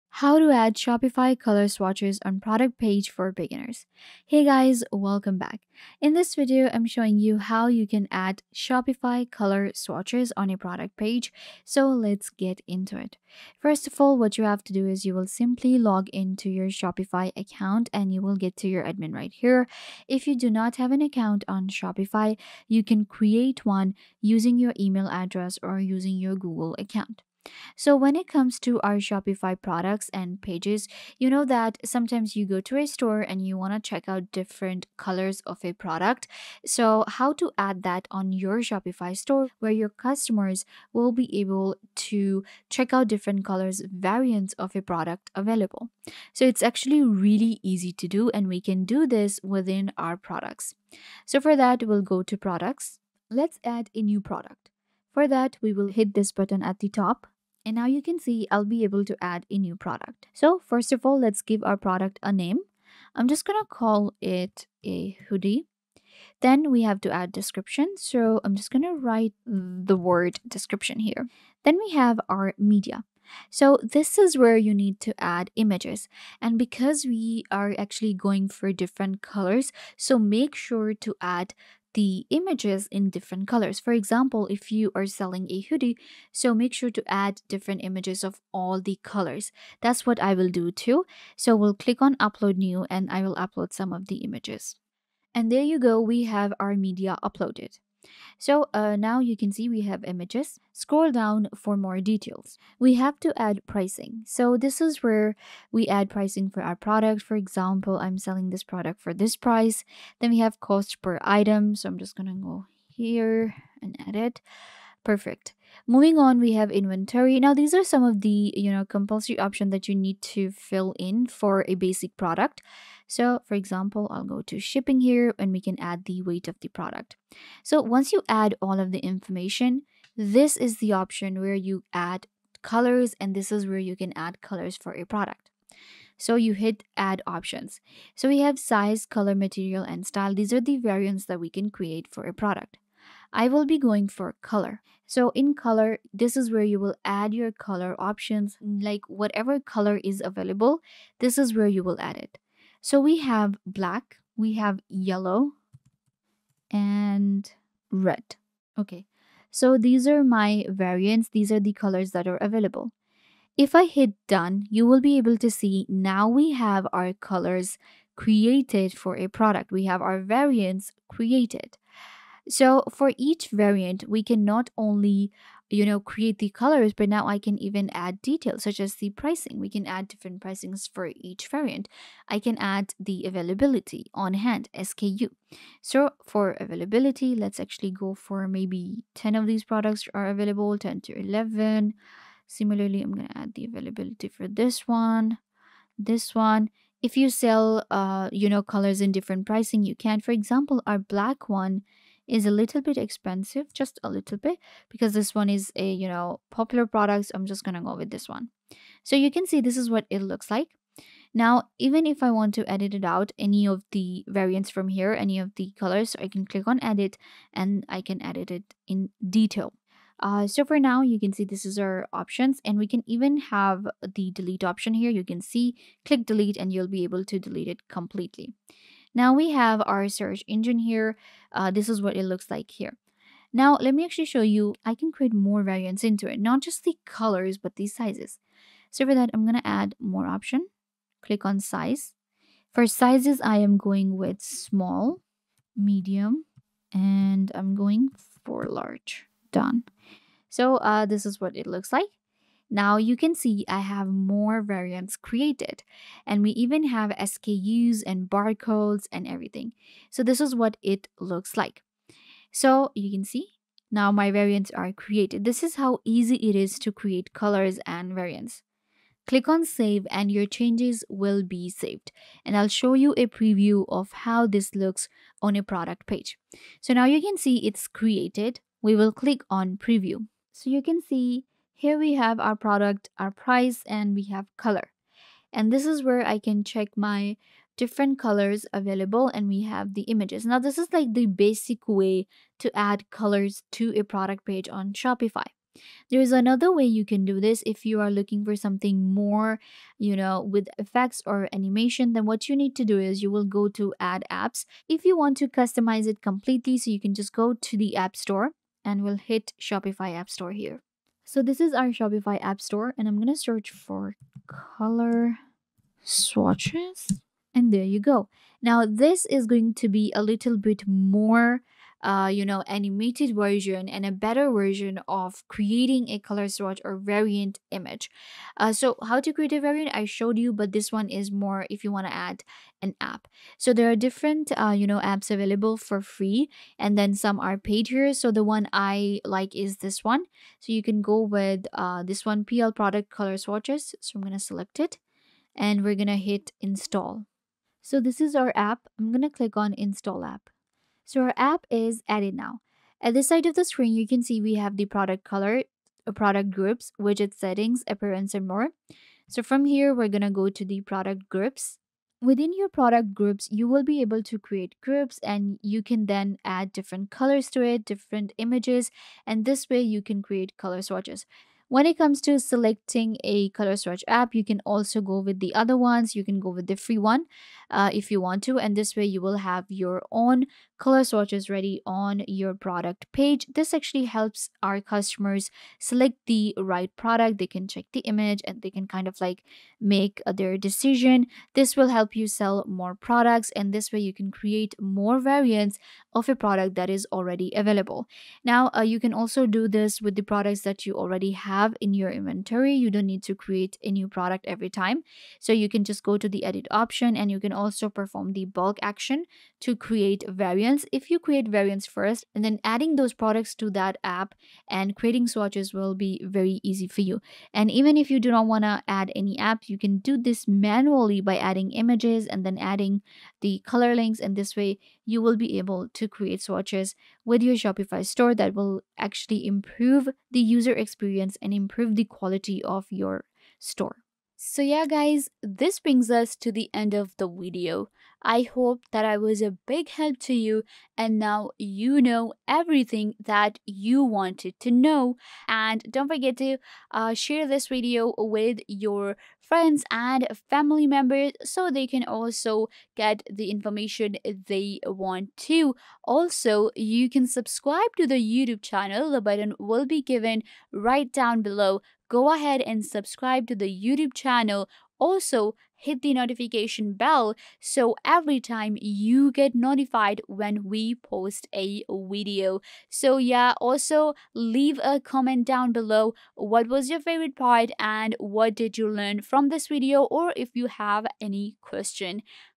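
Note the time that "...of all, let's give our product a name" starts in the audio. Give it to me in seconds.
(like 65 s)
60 s.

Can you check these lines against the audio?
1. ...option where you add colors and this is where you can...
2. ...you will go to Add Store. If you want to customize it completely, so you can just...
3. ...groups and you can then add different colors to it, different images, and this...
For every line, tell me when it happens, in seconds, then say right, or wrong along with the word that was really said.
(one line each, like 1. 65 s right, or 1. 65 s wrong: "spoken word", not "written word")
1. 130 s right
2. 303 s wrong: "Apps", not "Store"
3. 364 s right.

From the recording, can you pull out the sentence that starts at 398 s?
Now, uh, you can also do this with the products that you already have have in your inventory.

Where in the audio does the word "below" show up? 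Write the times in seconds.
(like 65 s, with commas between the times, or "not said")
461 s, 475 s.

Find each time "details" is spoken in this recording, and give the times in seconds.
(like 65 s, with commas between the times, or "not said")
101 s, 178 s, 219 s.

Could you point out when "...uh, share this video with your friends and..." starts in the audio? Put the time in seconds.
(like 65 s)
446 s.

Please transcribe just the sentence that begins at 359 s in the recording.
So from here, we're gonna go to the product groups.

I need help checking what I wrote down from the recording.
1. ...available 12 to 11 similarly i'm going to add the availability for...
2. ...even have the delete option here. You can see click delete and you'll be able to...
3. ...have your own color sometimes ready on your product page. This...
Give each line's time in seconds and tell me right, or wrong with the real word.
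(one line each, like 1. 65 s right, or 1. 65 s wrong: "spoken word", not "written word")
1. 190 s wrong: "10", not "12"
2. 223 s right
3. 379 s wrong: "swatches", not "sometimes".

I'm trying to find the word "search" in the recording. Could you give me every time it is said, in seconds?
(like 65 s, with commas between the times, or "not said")
230 s, 313 s.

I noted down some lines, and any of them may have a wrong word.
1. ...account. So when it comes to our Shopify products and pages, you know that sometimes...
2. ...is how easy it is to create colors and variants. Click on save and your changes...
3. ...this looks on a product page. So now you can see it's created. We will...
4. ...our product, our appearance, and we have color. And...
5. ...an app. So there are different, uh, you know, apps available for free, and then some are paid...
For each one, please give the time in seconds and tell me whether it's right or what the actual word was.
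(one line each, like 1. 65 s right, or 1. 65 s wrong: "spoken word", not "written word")
1. 26 s right
2. 265 s right
3. 274 s right
4. 282 s wrong: "price", not "appearance"
5. 332 s right.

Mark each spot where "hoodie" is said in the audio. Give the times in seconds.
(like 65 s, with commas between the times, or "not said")
65 s, 85 s.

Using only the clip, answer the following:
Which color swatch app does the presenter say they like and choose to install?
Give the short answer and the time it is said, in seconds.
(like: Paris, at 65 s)
PL Product Color Swatches, at 342 s.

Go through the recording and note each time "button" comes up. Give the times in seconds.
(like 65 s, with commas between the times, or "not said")
56 s, 459 s.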